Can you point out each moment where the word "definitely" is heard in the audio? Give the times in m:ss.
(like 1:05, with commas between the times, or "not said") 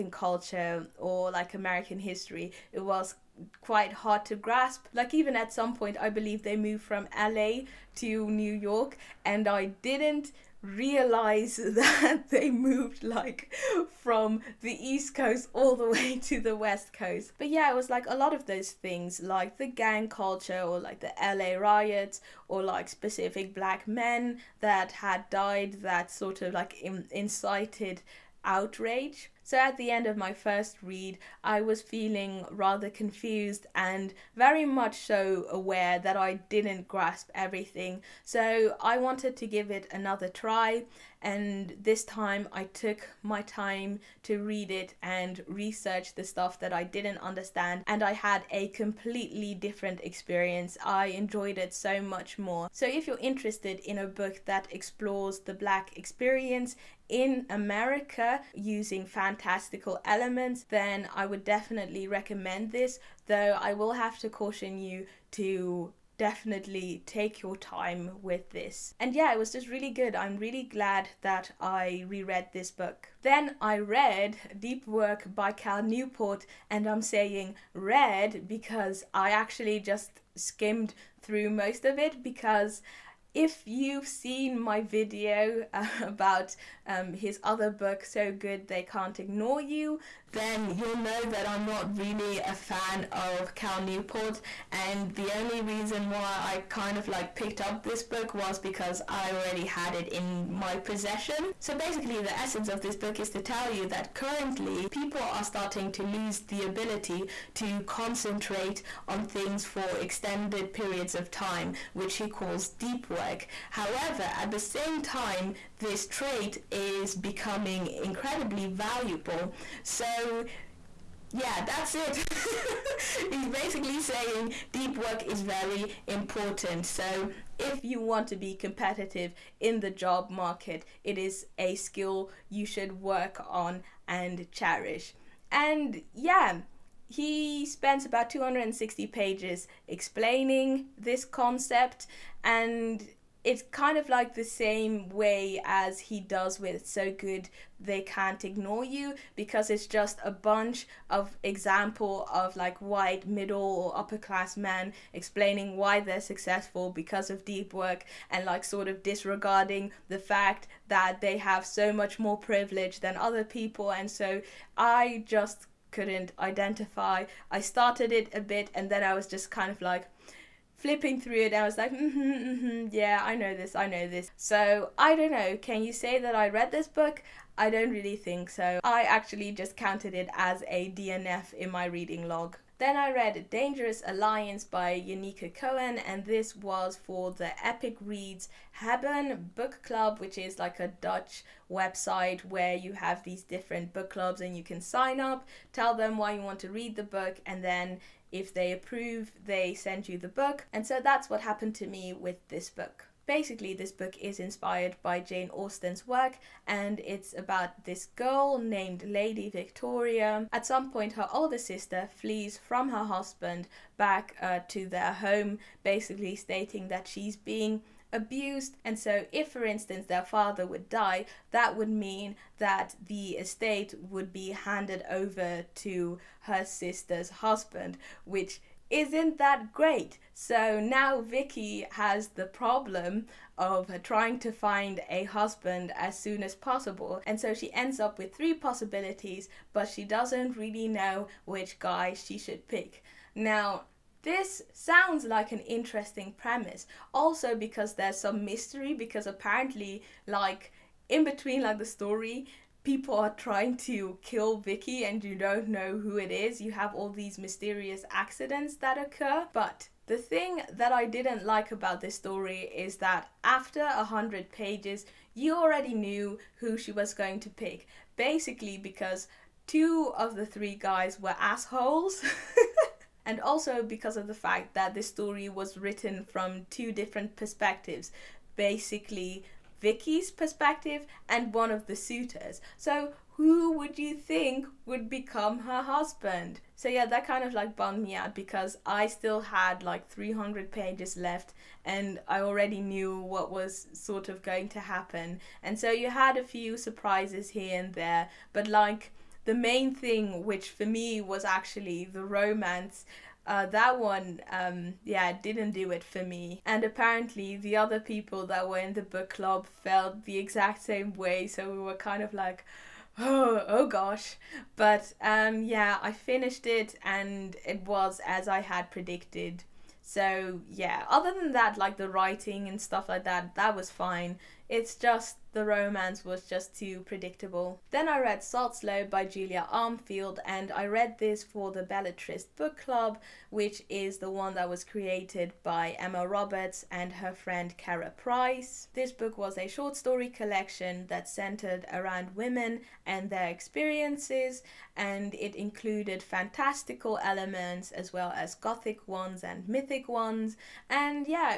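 1:01, 1:06.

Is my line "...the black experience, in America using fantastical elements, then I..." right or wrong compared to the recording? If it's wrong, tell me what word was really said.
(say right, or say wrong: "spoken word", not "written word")
right.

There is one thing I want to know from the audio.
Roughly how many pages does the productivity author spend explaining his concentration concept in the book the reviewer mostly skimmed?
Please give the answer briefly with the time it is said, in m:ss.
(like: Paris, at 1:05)
260, at 2:18.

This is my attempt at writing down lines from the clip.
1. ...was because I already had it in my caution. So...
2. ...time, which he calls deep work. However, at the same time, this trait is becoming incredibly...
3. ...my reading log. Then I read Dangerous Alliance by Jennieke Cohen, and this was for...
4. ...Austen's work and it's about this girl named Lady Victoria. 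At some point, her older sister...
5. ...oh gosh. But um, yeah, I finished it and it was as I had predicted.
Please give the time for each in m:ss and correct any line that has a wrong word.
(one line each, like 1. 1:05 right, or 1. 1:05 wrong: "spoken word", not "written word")
1. 1:38 wrong: "possession", not "caution"
2. 1:51 right
3. 3:01 right
4. 3:25 right
5. 5:13 right.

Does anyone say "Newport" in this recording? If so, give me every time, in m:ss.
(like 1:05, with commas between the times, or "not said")
1:15, 1:33.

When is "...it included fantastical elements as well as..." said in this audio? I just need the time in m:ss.
5:45.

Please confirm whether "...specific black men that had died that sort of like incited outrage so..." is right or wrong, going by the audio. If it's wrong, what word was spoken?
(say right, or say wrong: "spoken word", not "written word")
right.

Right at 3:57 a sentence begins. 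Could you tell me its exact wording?
And so she ends up with three possibilities, but she doesn't really know which guy she should pick.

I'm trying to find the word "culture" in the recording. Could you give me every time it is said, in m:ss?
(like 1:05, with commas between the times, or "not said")
0:00, 0:20.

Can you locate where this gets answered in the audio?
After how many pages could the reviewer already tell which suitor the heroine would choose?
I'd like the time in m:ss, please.
4:23.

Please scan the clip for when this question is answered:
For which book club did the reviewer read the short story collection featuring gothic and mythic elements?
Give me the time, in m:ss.
5:31.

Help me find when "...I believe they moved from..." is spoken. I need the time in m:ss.
0:05.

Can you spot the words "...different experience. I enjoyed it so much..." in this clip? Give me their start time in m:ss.
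0:49.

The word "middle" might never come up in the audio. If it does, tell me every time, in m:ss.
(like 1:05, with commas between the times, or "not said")
2:33.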